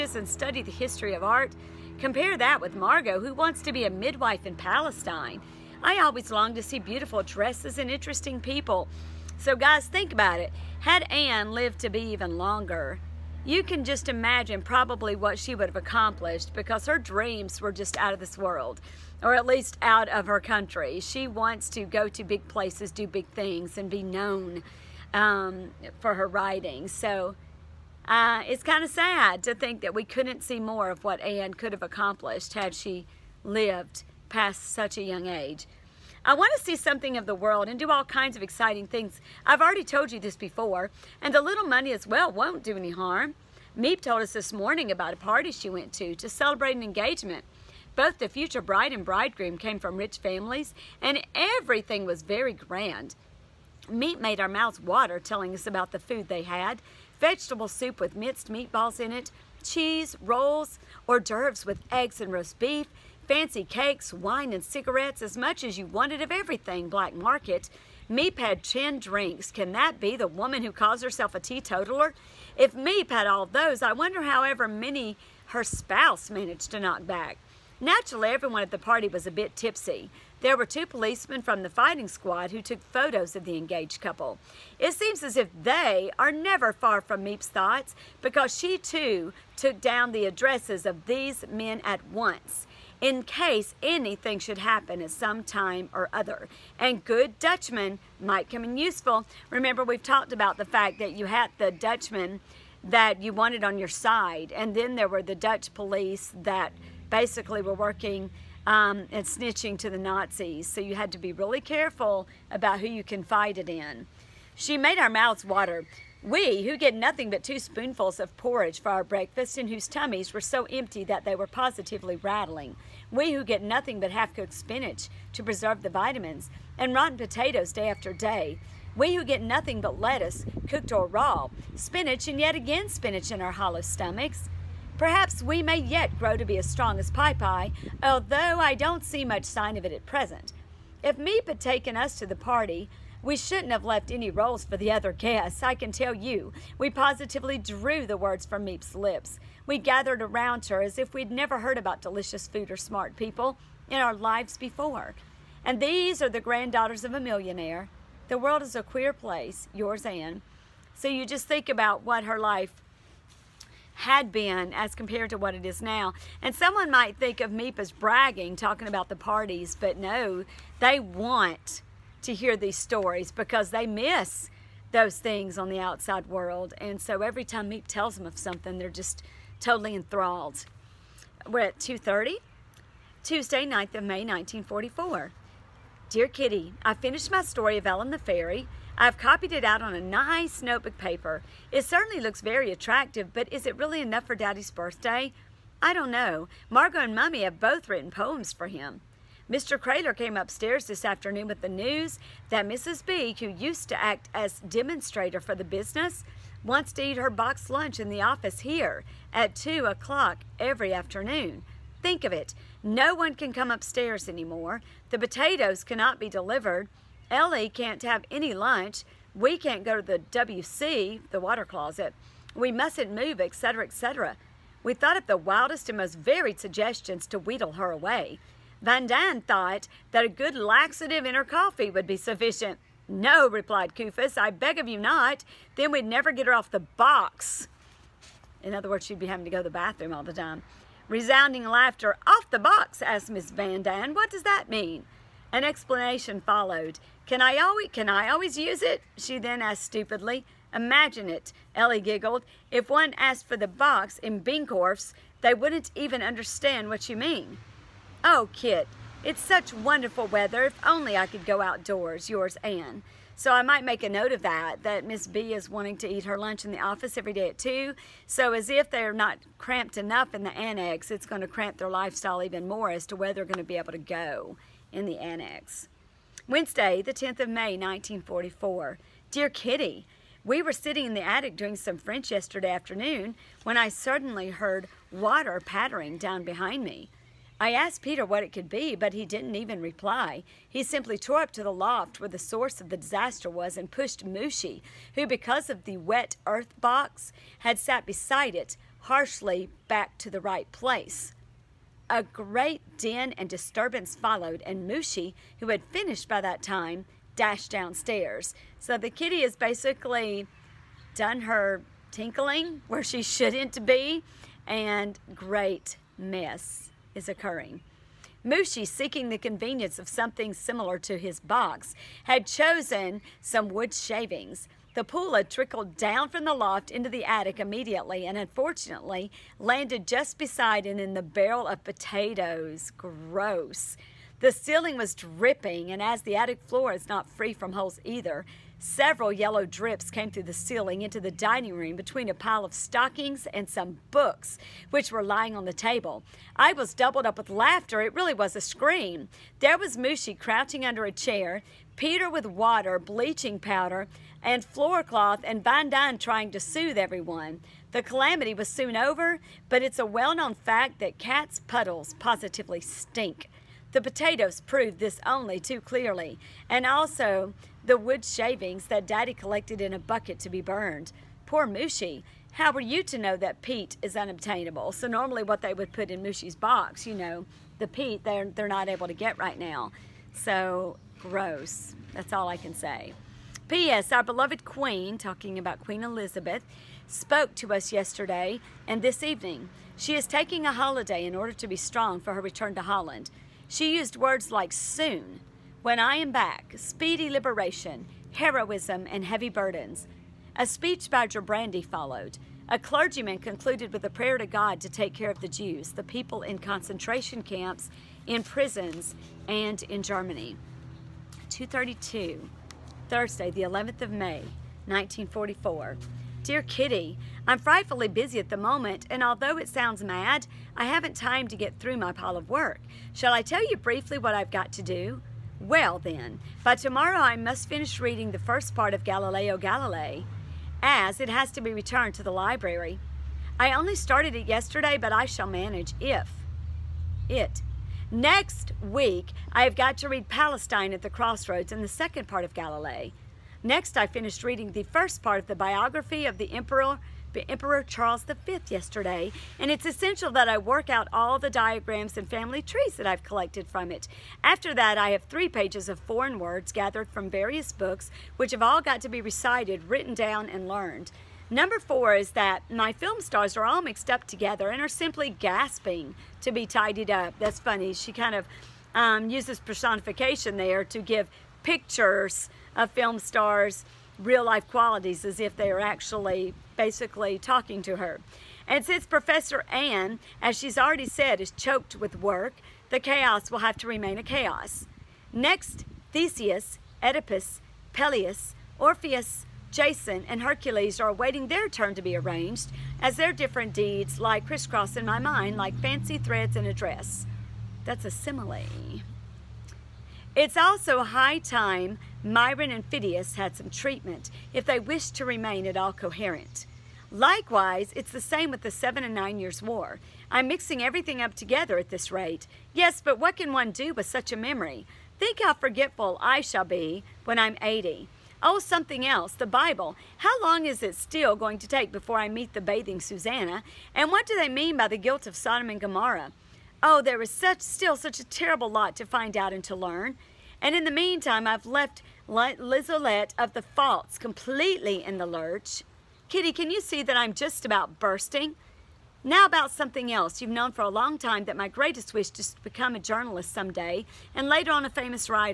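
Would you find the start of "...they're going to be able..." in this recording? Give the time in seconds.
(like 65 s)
273 s.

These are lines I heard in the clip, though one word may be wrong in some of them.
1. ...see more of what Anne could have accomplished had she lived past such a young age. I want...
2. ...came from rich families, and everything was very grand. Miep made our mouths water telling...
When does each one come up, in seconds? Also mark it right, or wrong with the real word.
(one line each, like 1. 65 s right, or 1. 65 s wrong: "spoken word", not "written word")
1. 30 s right
2. 49 s right.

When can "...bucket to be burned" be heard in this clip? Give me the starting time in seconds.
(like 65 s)
369 s.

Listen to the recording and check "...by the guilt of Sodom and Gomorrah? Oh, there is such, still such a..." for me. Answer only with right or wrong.
right.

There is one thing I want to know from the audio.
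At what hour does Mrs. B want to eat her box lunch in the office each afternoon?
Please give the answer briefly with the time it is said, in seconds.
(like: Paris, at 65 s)
2 o'clock, at 209 s.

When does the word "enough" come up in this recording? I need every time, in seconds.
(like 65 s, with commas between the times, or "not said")
194 s, 269 s.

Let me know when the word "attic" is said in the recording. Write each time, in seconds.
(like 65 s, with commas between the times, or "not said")
281 s, 327 s, 336 s.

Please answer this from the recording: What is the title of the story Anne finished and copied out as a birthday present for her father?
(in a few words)
Ellen the Fairy.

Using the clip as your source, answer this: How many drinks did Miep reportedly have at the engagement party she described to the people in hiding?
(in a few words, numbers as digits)
10.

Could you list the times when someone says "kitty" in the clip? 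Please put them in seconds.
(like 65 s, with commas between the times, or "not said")
186 s, 279 s, 309 s, 416 s, 536 s.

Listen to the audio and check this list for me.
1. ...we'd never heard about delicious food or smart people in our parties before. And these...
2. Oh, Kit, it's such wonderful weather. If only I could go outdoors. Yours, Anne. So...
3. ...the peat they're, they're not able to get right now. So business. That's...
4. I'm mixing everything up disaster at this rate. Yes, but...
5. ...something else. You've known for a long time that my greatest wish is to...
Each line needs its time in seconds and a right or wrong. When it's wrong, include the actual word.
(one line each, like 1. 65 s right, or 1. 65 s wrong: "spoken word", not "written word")
1. 151 s wrong: "lives", not "parties"
2. 258 s right
3. 377 s wrong: "gross", not "business"
4. 510 s wrong: "together", not "disaster"
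5. 539 s right.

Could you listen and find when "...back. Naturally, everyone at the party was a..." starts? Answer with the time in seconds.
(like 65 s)
77 s.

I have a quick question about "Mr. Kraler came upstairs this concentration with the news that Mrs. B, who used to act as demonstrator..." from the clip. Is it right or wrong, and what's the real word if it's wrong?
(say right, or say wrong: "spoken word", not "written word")
wrong: "afternoon", not "concentration".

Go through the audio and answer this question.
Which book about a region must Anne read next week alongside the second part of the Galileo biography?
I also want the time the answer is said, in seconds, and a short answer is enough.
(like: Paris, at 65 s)
Palestine at the Crossroads, at 440 s.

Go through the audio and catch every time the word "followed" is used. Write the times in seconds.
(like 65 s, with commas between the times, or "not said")
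246 s, 304 s, 401 s.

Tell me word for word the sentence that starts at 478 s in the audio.
And since Professor Anne, as she's already said, is choked with work, the chaos will have to remain a chaos.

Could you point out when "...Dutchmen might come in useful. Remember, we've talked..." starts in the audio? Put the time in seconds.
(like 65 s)
97 s.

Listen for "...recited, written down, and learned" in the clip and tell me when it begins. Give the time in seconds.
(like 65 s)
459 s.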